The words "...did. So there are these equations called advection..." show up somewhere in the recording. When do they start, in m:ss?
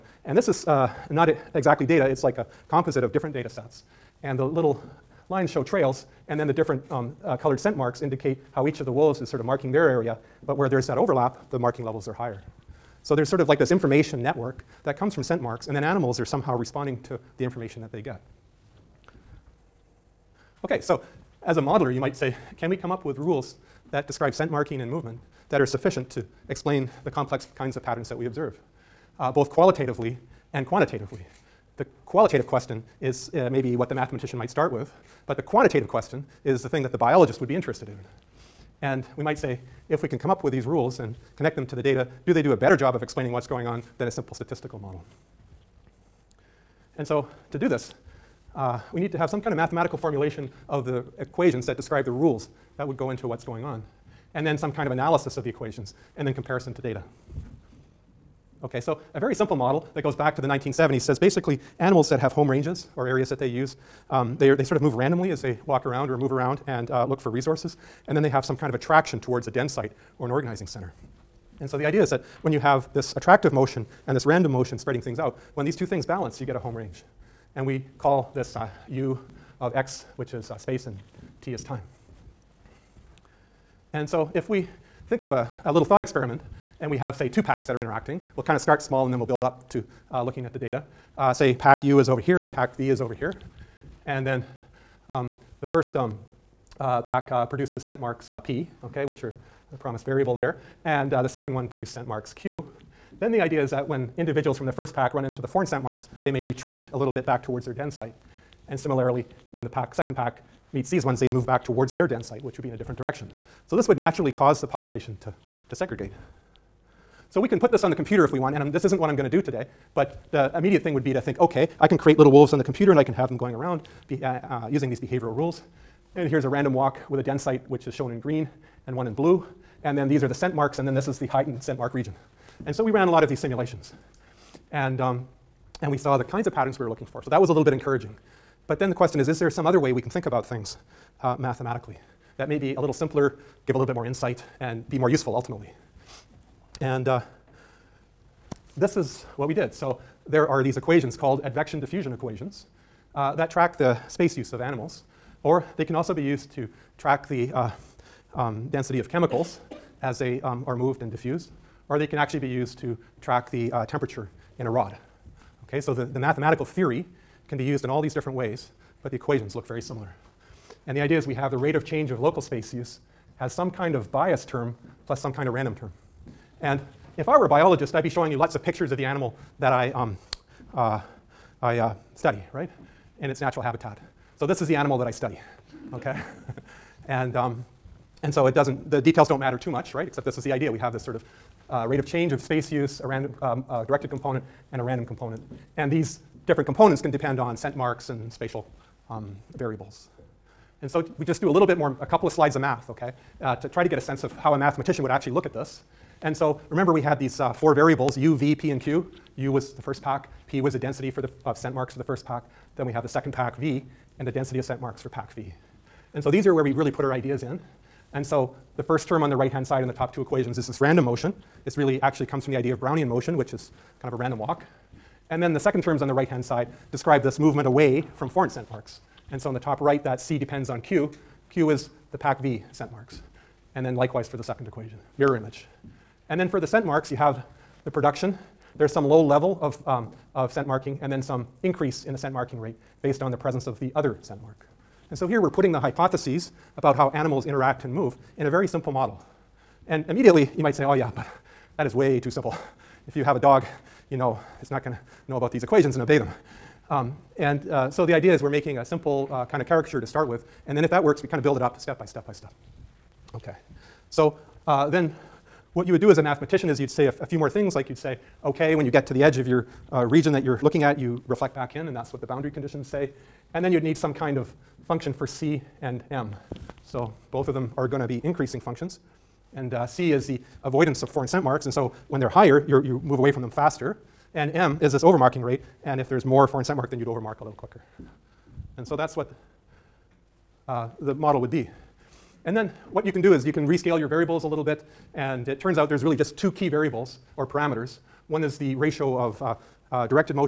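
2:29.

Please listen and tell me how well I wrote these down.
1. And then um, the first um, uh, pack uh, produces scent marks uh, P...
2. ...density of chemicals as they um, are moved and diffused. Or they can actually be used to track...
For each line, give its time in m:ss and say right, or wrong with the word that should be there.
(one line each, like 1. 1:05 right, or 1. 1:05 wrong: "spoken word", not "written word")
1. 1:34 right
2. 2:38 right.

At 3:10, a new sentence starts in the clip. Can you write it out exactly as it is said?
We have this sort of uh, rate of change of space use, a random, um, uh, directed component, and a random component.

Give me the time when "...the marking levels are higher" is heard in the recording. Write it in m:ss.
0:11.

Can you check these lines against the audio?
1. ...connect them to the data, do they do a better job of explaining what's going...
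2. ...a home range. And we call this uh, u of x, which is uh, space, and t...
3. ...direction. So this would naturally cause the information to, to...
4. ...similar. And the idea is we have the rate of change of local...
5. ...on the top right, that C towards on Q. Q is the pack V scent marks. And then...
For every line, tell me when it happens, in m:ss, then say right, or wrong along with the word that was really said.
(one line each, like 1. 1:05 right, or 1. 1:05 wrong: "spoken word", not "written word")
1. 0:41 right
2. 1:16 right
3. 1:52 wrong: "population", not "information"
4. 2:49 right
5. 3:49 wrong: "depends", not "towards".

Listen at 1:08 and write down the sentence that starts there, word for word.
And then they have some kind of attraction towards a den site or an organizing center.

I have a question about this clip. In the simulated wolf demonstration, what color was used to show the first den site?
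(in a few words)
Green.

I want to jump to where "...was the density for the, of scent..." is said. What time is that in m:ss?
3:30.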